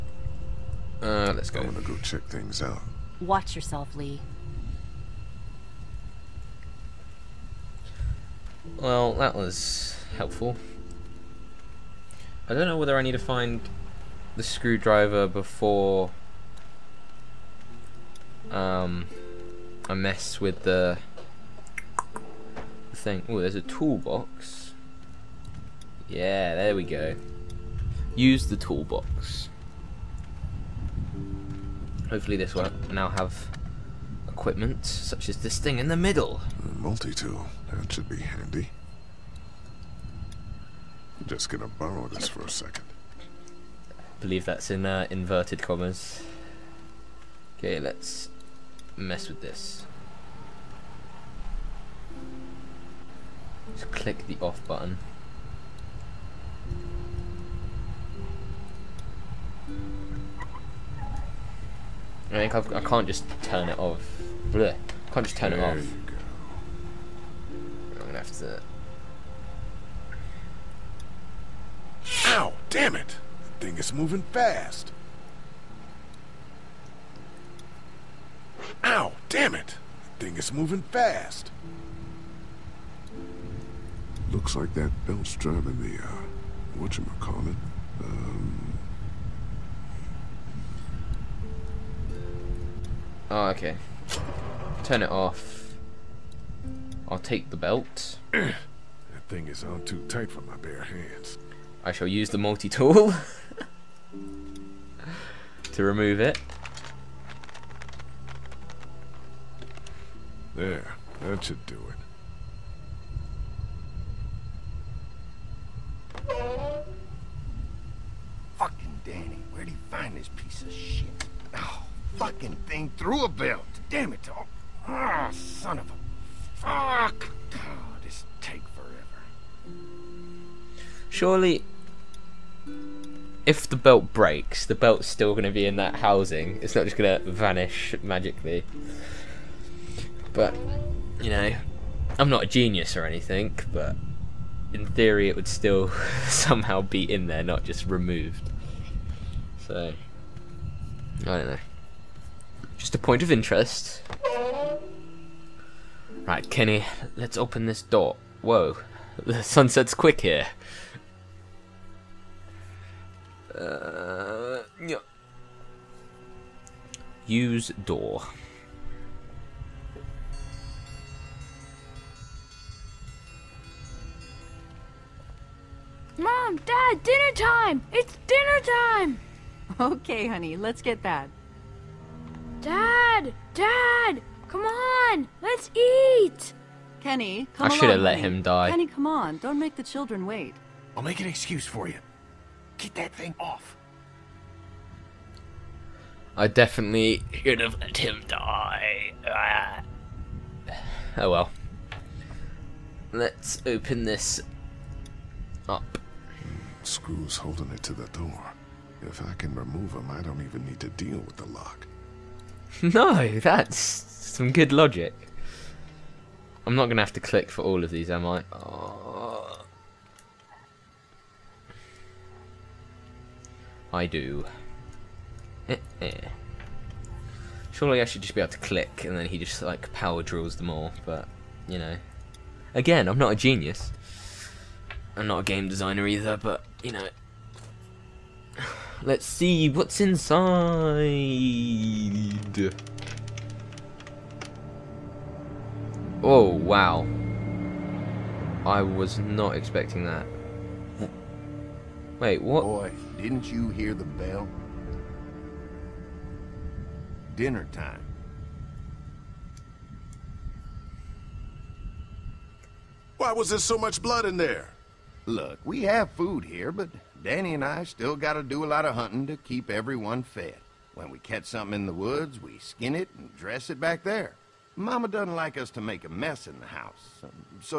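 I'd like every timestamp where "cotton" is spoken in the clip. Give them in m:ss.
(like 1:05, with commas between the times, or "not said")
not said.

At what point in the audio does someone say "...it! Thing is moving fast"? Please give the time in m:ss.
1:19.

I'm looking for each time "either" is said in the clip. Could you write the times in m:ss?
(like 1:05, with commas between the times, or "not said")
3:56.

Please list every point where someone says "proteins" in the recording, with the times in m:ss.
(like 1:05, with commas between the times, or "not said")
not said.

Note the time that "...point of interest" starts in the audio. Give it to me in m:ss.
2:32.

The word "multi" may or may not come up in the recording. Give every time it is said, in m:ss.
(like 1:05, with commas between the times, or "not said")
0:36, 1:42.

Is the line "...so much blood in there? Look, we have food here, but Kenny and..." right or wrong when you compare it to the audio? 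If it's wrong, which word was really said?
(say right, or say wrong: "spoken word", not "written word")
wrong: "Danny", not "Kenny".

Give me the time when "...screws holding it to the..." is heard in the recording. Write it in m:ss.
3:26.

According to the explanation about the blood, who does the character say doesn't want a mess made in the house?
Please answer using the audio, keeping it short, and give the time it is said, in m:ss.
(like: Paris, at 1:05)
Mama, at 4:34.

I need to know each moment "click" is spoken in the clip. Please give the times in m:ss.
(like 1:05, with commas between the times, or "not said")
0:53, 3:37, 3:48.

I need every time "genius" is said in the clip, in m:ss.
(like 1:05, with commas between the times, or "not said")
2:22, 3:53.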